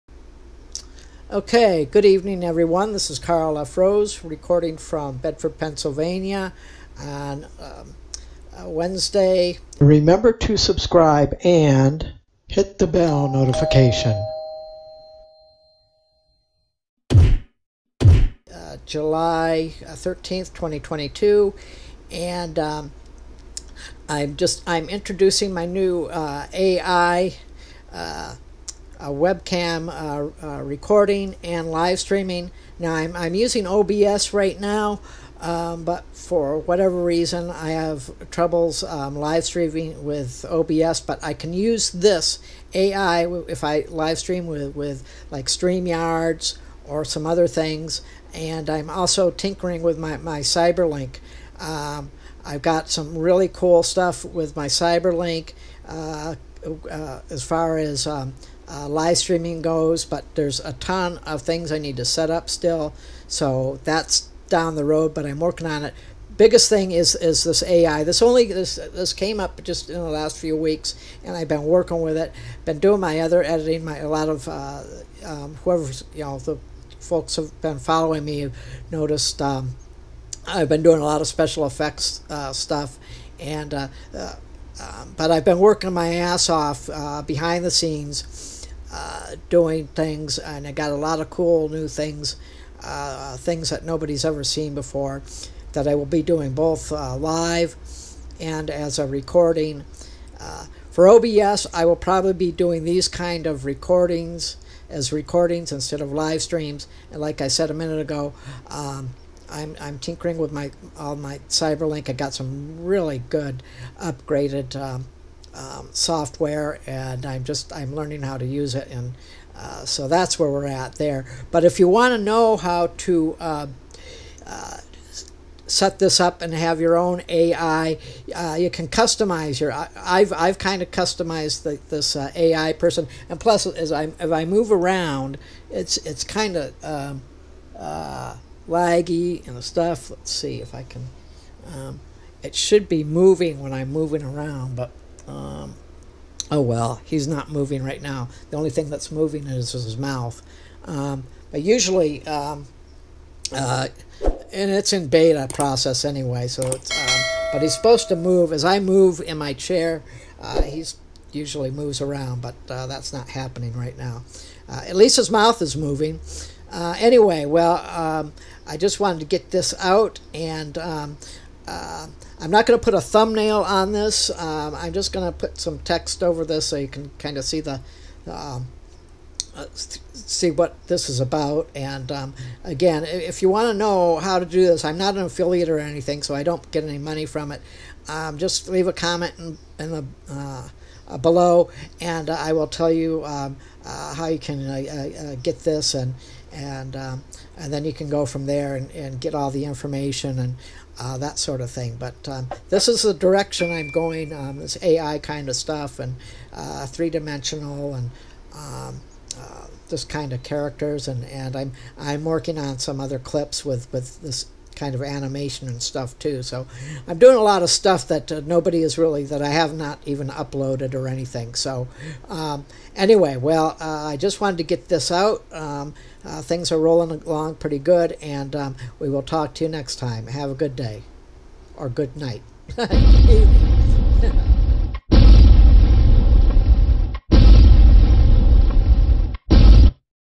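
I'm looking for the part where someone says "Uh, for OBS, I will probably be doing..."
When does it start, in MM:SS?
01:40.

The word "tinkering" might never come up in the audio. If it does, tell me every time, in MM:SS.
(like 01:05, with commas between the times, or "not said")
00:49, 01:49.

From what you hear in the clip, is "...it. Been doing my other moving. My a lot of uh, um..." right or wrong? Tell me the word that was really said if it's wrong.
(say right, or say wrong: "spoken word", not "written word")
wrong: "editing", not "moving".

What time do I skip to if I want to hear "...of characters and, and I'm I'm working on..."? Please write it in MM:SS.
03:30.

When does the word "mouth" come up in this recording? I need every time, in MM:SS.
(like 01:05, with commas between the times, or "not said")
02:29, 02:45.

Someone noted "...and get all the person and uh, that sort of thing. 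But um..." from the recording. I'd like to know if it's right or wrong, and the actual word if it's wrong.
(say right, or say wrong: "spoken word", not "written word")
wrong: "information", not "person".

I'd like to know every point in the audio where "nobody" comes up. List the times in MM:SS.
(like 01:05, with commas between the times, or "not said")
01:33, 03:38.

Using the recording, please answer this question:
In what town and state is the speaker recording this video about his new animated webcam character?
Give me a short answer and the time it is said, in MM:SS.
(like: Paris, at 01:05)
Bedford, Pennsylvania, at 00:05.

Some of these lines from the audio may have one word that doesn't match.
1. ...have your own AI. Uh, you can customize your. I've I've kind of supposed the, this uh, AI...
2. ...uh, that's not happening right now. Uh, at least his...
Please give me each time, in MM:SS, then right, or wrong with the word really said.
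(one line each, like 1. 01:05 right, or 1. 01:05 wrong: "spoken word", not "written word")
1. 02:06 wrong: "customized", not "supposed"
2. 02:42 right.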